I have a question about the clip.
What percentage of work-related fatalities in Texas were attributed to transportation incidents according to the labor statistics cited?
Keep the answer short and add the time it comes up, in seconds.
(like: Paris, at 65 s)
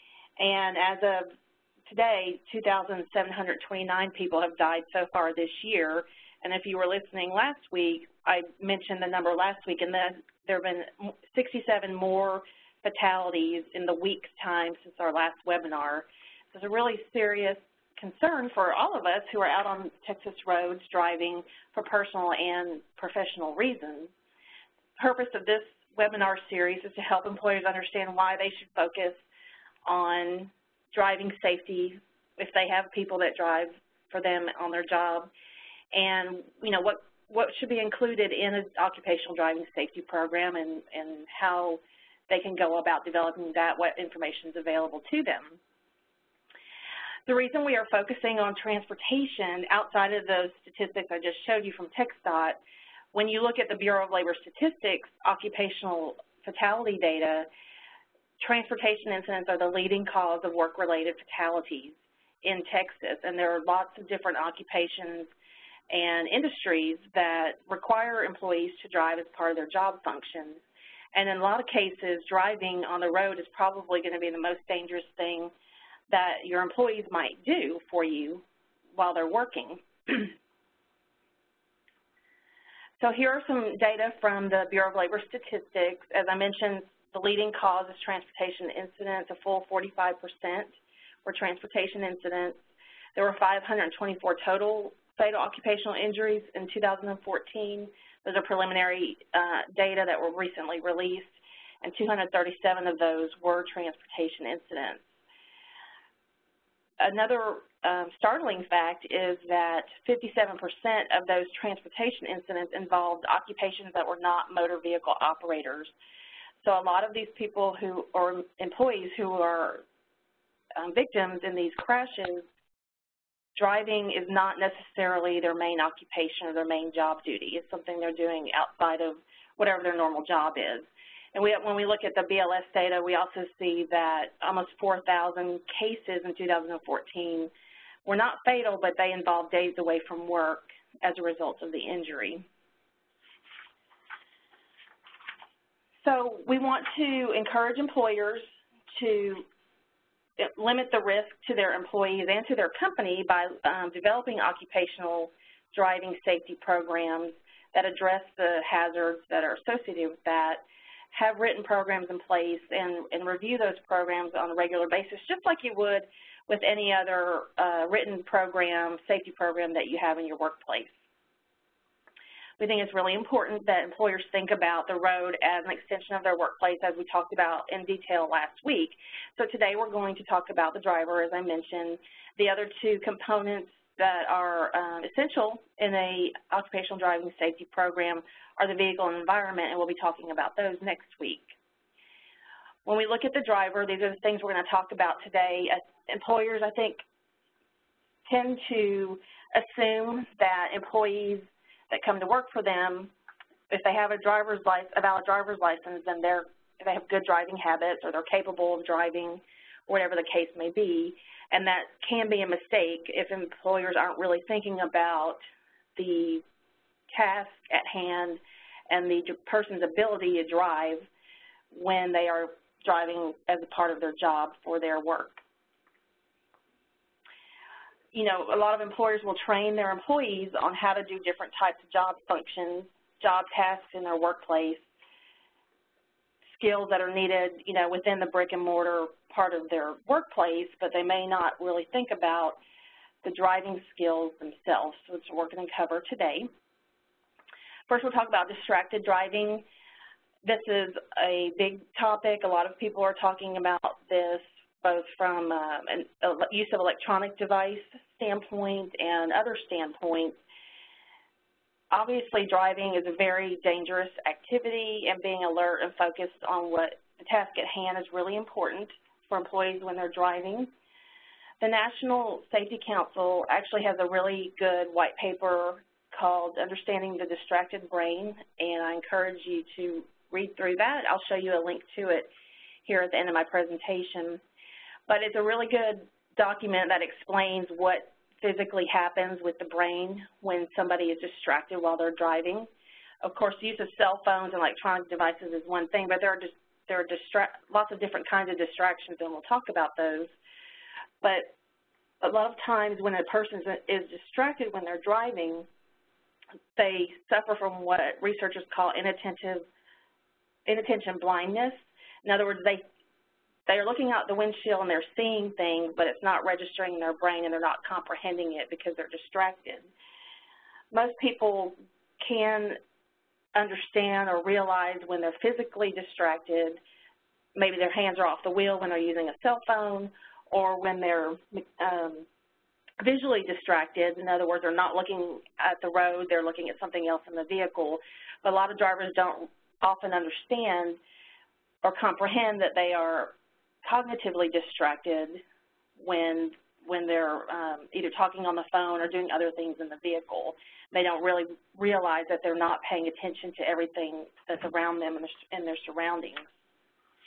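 45%, at 89 s.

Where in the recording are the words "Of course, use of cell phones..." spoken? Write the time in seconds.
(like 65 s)
293 s.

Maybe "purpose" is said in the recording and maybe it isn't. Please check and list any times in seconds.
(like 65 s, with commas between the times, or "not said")
25 s.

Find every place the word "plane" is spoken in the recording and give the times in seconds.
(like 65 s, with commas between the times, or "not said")
not said.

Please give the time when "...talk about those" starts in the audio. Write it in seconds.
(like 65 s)
299 s.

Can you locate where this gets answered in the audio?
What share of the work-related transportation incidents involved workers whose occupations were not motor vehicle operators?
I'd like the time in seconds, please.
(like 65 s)
110 s.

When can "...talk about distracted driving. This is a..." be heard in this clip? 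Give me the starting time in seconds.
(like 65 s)
248 s.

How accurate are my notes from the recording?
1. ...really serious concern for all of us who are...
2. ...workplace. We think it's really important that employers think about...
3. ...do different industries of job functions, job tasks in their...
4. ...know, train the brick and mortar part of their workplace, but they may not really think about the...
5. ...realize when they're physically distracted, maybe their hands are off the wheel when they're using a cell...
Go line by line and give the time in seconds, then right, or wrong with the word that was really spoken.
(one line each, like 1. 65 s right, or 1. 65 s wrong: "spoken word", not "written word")
1. 16 s right
2. 170 s right
3. 231 s wrong: "types", not "industries"
4. 237 s wrong: "within", not "train"
5. 324 s right.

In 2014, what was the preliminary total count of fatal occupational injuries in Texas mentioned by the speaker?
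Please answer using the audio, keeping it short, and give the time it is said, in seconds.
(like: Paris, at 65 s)
524, at 93 s.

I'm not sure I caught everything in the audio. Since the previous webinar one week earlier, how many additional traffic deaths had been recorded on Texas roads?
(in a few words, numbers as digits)
67.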